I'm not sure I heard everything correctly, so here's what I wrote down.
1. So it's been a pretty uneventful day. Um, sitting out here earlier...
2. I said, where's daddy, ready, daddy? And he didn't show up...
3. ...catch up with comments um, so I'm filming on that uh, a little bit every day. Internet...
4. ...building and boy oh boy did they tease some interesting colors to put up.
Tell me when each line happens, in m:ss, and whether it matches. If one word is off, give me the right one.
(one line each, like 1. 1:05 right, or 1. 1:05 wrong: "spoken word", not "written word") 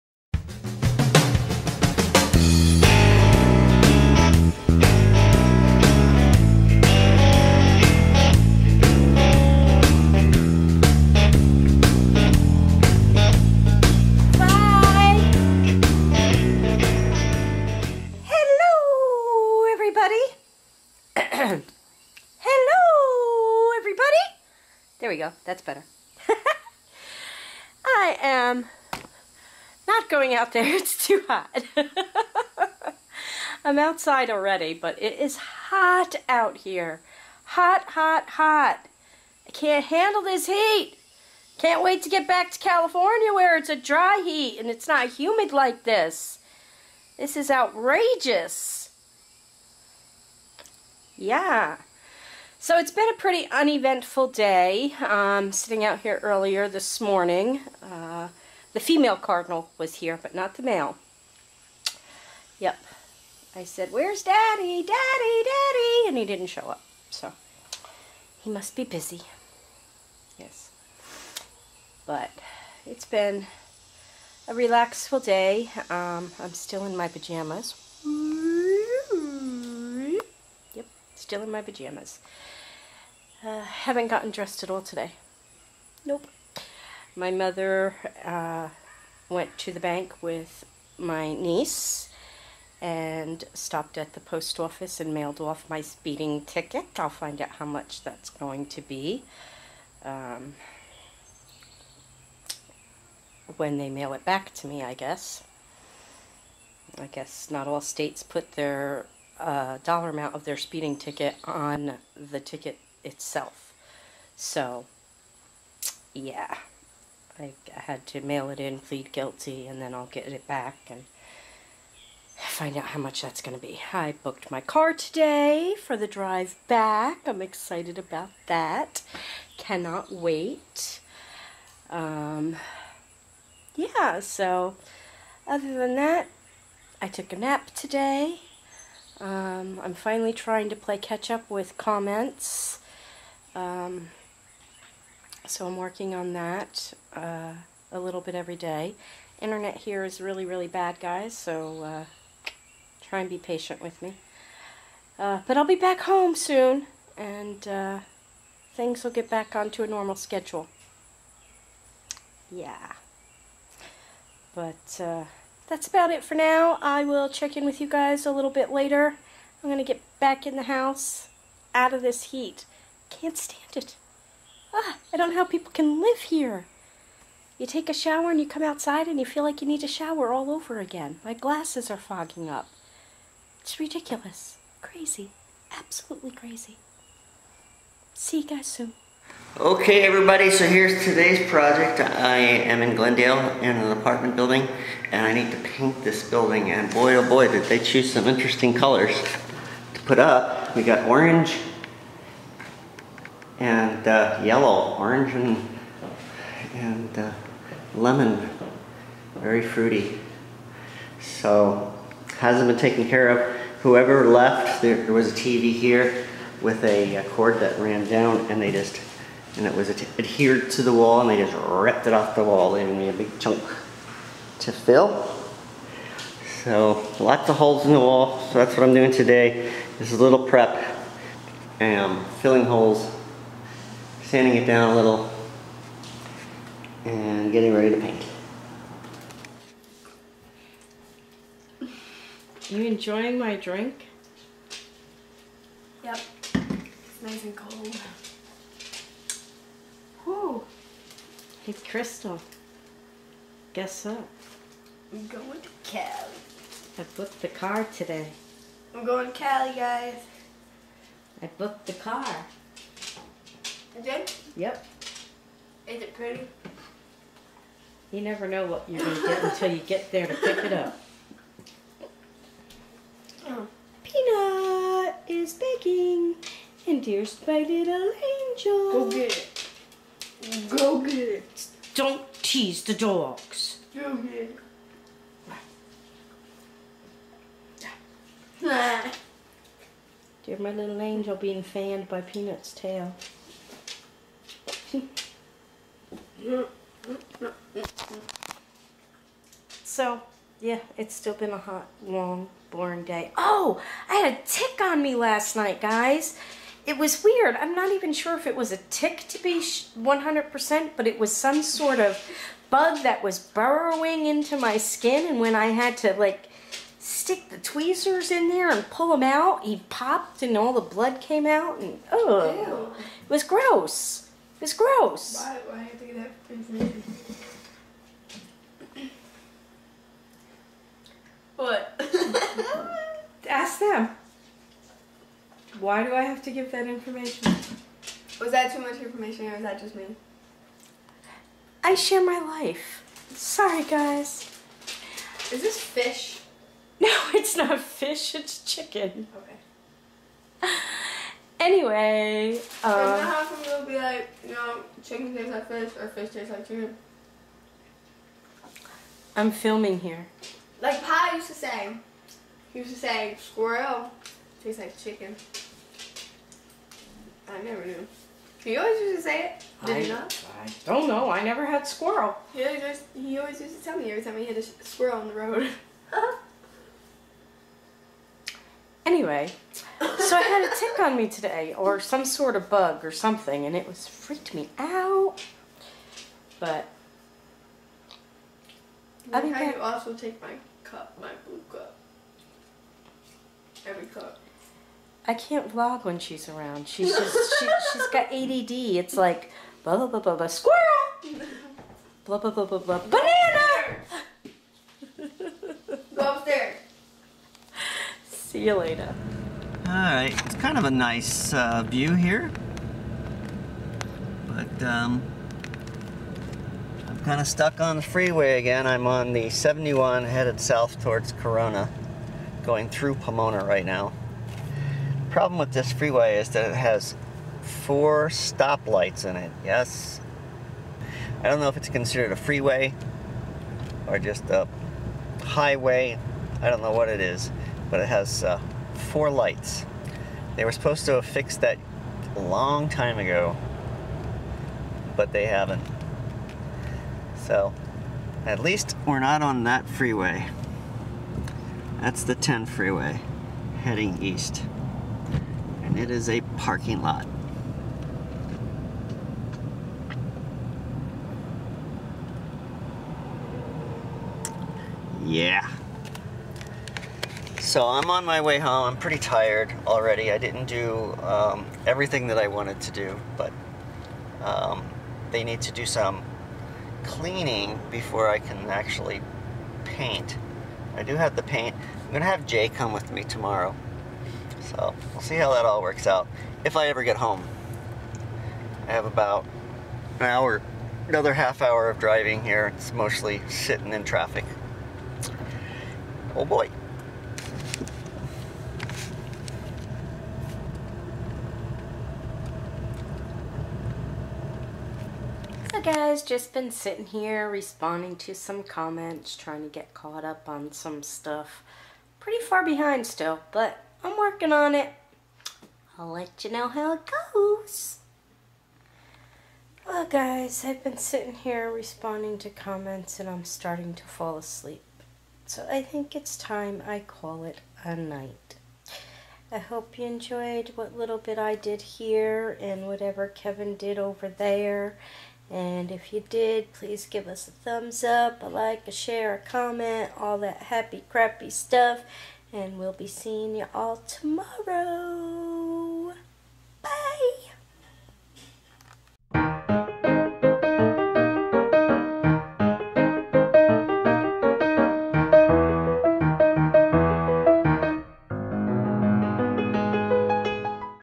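1. 0:52 right
2. 1:03 wrong: "daddy", not "ready"
3. 2:20 wrong: "working", not "filming"
4. 3:16 wrong: "choose", not "tease".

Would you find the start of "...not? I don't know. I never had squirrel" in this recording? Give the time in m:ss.
6:10.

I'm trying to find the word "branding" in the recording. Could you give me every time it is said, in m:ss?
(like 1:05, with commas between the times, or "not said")
not said.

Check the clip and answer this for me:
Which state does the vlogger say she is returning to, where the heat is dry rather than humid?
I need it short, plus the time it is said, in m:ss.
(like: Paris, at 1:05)
California, at 0:42.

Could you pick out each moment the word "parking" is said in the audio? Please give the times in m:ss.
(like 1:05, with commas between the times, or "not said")
7:36.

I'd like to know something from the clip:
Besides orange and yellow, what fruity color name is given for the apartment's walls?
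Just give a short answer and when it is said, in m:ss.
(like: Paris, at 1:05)
lemon, at 3:27.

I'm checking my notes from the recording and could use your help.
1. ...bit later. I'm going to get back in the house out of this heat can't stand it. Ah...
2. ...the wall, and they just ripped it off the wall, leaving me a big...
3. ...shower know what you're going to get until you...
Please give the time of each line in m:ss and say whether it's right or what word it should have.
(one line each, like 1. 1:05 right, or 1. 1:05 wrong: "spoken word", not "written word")
1. 2:48 right
2. 3:40 right
3. 4:28 wrong: "never", not "shower".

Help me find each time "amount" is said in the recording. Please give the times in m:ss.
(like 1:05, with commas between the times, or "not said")
1:50.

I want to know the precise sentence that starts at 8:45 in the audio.
So I think it's time I call it a night.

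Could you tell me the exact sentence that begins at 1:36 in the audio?
I'll find out how much that's going to be um, when they mail it back to me, I guess.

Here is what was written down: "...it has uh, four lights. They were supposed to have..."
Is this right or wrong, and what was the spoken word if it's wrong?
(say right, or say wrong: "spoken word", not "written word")
right.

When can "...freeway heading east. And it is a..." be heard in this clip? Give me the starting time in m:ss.
7:32.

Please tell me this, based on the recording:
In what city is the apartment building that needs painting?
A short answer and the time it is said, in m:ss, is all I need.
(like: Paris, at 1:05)
Glendale, at 3:12.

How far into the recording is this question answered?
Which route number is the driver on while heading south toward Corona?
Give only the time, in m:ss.
6:59.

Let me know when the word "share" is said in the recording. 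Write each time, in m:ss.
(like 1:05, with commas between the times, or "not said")
5:41, 8:58.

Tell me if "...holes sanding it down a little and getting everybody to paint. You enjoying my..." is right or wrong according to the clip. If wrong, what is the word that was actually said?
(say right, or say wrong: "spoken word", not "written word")
wrong: "ready", not "everybody".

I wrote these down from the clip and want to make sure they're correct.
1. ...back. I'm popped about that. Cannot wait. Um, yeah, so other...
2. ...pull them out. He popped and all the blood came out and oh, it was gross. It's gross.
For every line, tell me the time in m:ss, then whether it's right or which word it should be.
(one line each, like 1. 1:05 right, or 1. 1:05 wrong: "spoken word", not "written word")
1. 2:06 wrong: "excited", not "popped"
2. 5:18 right.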